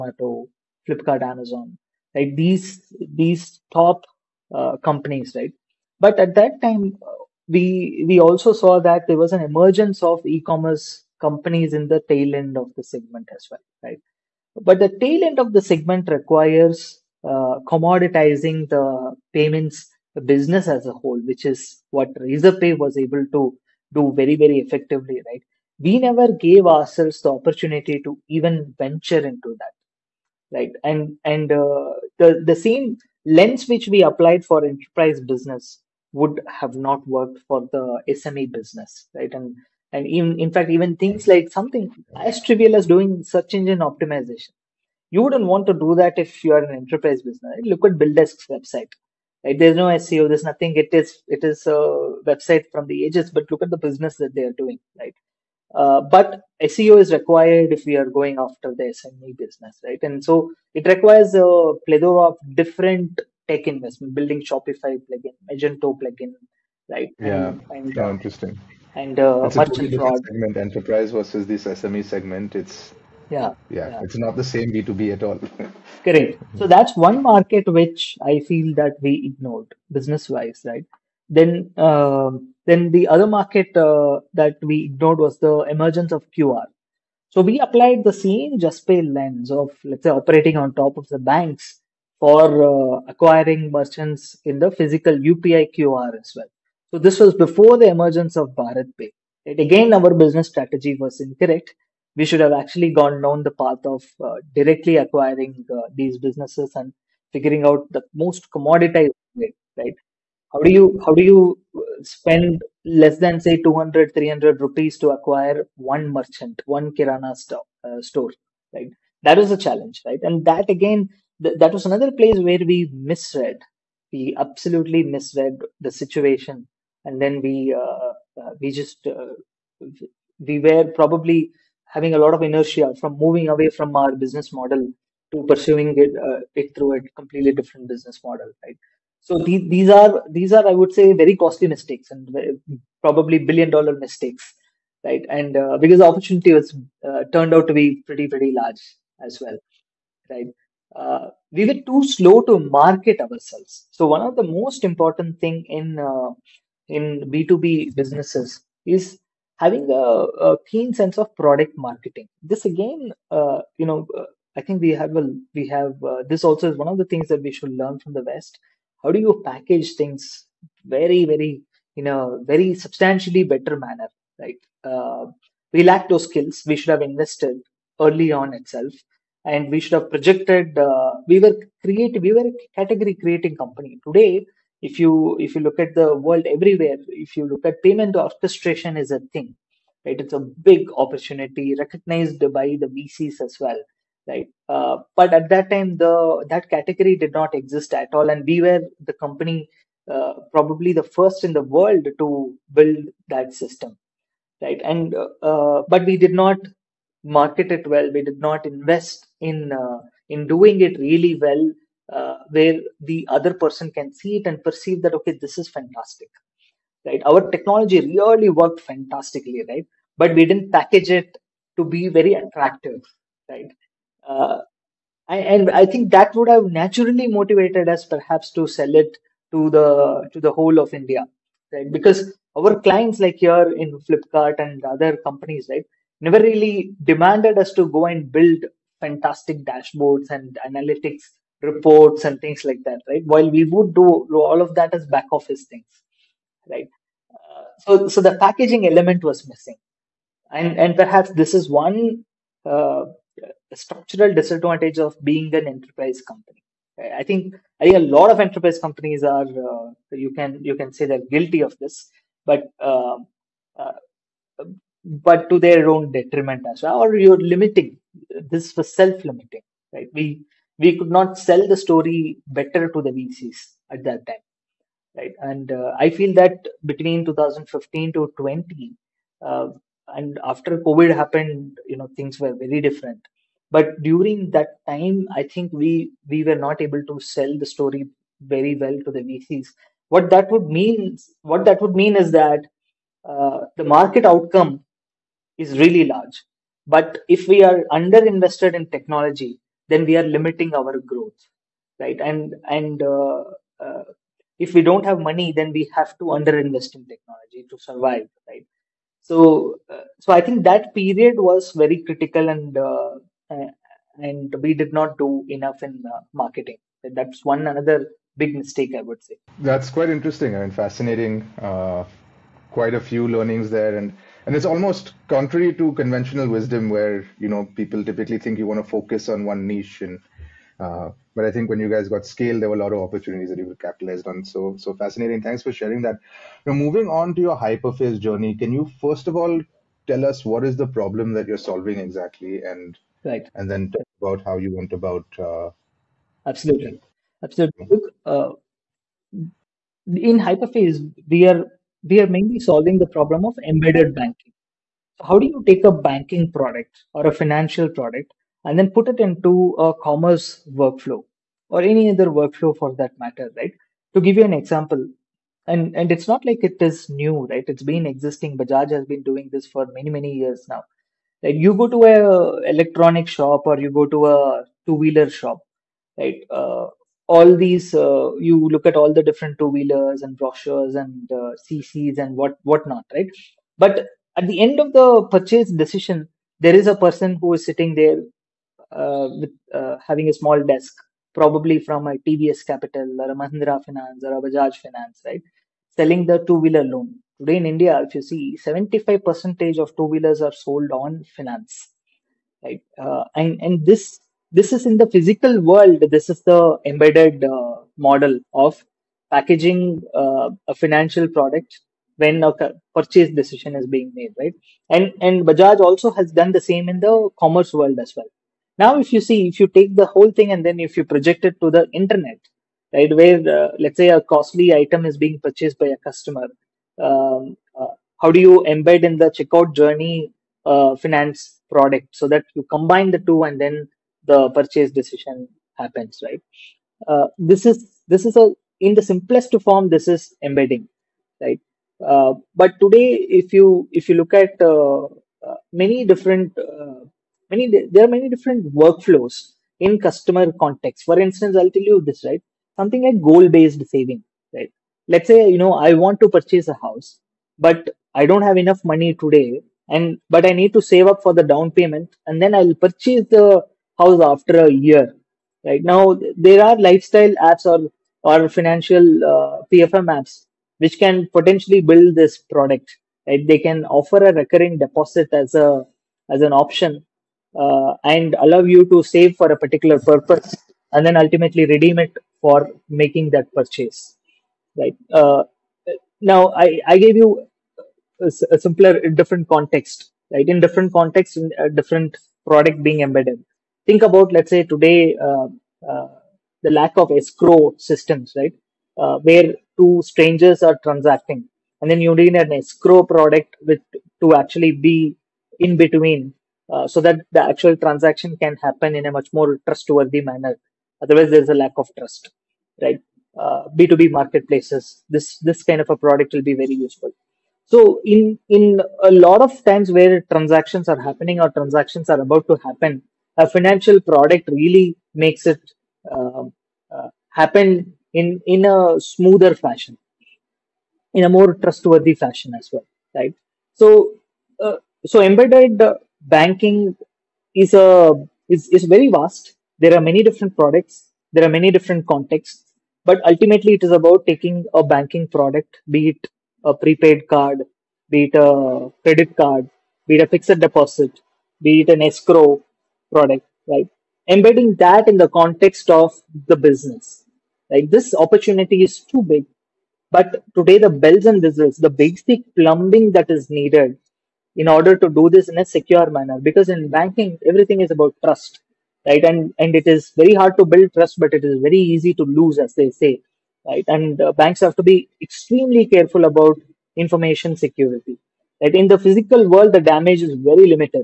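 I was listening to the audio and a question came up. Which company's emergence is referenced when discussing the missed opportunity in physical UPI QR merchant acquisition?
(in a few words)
Bharat Pay.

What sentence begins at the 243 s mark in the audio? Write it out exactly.
While we would do all of that as back office things, right?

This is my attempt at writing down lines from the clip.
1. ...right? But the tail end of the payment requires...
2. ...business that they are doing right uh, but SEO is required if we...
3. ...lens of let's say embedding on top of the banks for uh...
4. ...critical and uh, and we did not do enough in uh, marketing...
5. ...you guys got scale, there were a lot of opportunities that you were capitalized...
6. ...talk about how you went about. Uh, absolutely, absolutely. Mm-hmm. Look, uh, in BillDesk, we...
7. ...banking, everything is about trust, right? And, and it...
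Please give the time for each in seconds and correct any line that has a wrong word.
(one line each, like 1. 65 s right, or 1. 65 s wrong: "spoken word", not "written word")
1. 13 s wrong: "segment", not "payment"
2. 53 s right
3. 89 s wrong: "operating", not "embedding"
4. 312 s right
5. 331 s right
6. 343 s wrong: "Hyperface", not "BillDesk"
7. 566 s right.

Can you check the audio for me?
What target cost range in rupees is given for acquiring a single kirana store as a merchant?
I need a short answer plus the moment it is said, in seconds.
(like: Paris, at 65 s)
200-300 rupees, at 113 s.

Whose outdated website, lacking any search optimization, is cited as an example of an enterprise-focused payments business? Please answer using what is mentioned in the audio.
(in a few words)
BillDesk.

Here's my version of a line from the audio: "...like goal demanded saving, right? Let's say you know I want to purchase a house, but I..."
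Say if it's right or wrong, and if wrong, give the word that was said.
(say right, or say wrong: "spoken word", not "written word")
wrong: "based", not "demanded".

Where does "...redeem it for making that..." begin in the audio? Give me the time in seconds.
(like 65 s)
481 s.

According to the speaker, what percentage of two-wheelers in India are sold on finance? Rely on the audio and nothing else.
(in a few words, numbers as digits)
75%.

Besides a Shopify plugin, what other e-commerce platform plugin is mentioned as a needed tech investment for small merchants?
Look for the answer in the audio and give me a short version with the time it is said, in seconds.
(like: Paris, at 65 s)
Magento, at 65 s.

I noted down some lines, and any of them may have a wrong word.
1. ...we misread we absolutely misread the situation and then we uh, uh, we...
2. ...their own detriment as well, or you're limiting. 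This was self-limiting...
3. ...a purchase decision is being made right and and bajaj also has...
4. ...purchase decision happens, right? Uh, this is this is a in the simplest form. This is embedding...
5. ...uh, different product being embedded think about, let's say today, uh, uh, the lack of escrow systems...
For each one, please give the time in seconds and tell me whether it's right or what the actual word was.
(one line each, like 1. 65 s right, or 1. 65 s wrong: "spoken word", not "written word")
1. 122 s right
2. 265 s right
3. 412 s right
4. 434 s right
5. 491 s right.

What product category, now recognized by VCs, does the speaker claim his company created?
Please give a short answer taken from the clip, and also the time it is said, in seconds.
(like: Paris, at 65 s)
Payment orchestration, at 187 s.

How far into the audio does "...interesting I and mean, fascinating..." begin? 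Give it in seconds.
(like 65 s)
320 s.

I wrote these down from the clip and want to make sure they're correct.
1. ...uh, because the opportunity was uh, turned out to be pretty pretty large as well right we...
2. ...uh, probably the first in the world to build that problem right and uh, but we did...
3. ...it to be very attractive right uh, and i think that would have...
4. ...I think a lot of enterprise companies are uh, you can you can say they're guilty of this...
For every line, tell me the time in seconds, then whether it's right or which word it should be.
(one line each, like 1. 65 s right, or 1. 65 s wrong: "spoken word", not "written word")
1. 145 s right
2. 200 s wrong: "system", not "problem"
3. 221 s right
4. 257 s right.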